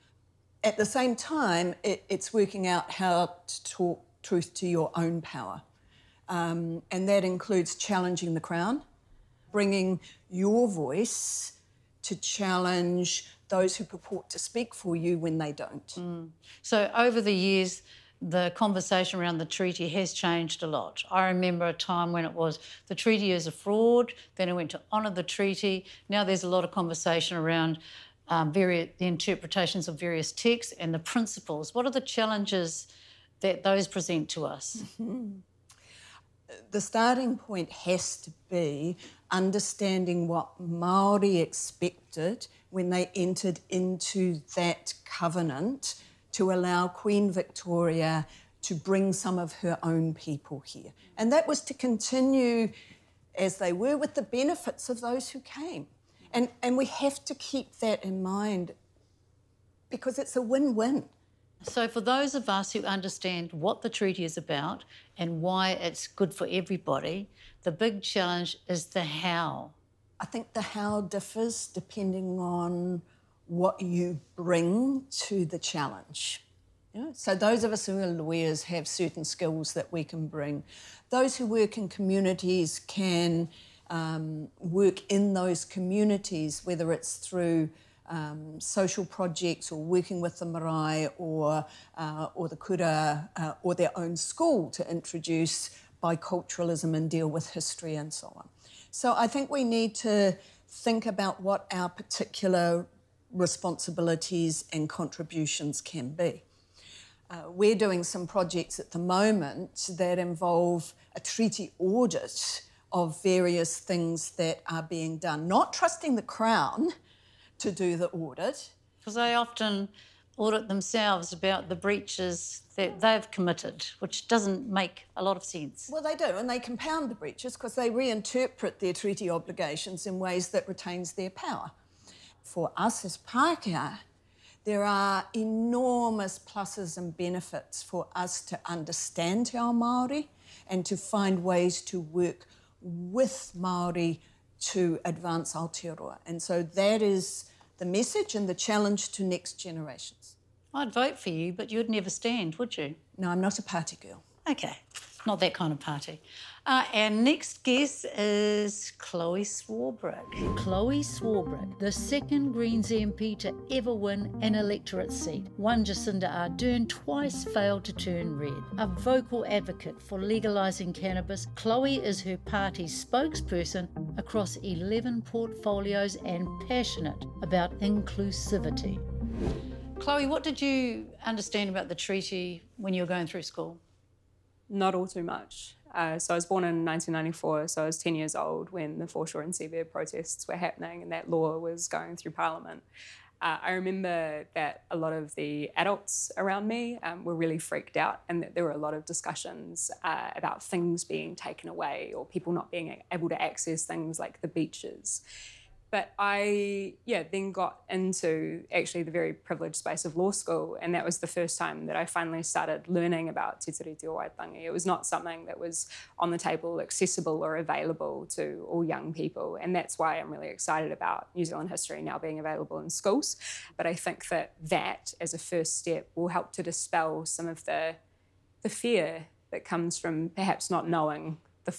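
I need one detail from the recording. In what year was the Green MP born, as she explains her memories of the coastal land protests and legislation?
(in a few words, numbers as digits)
1994.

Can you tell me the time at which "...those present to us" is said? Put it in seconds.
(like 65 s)
33 s.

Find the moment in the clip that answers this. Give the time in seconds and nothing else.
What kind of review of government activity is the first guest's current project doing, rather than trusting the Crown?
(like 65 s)
111 s.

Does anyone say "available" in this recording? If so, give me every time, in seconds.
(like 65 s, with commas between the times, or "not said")
217 s, 222 s.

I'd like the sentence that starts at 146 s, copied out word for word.
And so that is the message and the challenge to next generations.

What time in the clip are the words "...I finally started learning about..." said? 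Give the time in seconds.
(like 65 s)
211 s.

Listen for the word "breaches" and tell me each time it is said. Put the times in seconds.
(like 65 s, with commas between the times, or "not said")
121 s, 127 s.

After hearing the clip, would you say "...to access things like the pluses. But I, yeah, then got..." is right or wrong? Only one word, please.
wrong.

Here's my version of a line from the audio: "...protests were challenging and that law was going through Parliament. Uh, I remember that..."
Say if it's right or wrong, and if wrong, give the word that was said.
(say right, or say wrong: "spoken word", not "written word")
wrong: "happening", not "challenging".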